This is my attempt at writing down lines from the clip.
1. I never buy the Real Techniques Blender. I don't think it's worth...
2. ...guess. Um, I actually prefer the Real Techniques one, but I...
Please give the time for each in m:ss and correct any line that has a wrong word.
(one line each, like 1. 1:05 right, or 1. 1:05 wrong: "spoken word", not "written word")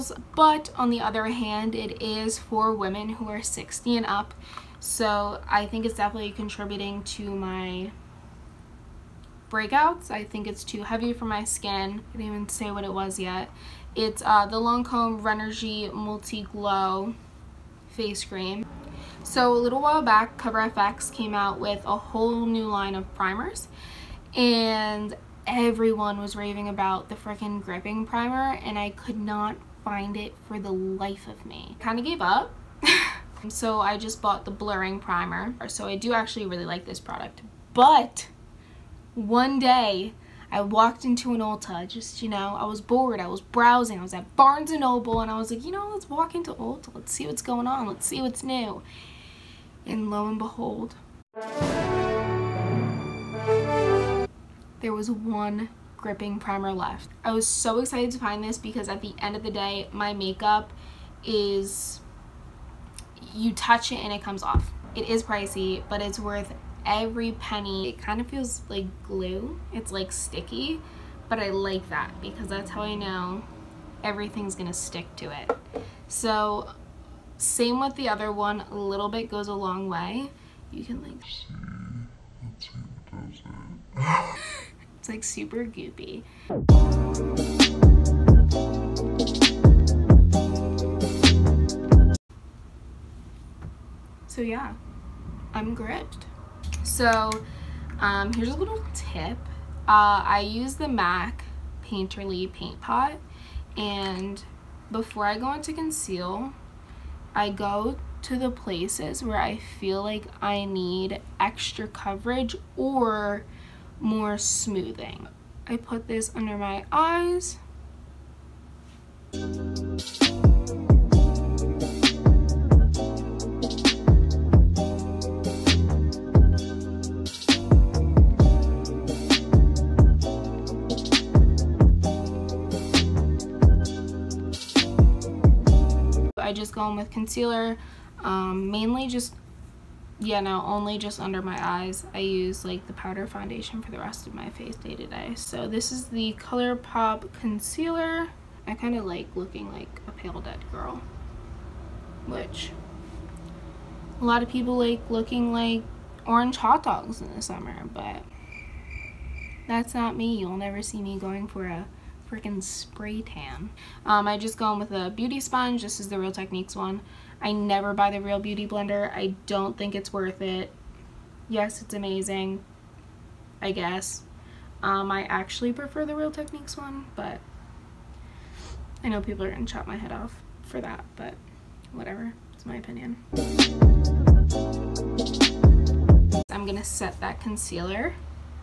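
1. 2:47 wrong: "Beauty", not "Techniques"
2. 2:53 right.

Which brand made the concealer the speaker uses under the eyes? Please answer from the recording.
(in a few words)
ColourPop.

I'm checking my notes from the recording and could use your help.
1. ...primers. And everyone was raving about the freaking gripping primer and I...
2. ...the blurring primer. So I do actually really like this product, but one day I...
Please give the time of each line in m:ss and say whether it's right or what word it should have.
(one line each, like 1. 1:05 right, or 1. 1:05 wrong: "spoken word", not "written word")
1. 0:23 right
2. 0:34 right.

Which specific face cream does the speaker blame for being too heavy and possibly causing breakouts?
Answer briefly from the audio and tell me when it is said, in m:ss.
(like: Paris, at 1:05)
Lancome Rénergie Multi Glow Face Cream, at 0:14.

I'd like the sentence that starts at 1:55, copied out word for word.
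I put this under my eyes.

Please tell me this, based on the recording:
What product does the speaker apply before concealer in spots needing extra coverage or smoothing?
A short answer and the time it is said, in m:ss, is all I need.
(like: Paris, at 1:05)
MAC Painterly Paint Pot, at 1:40.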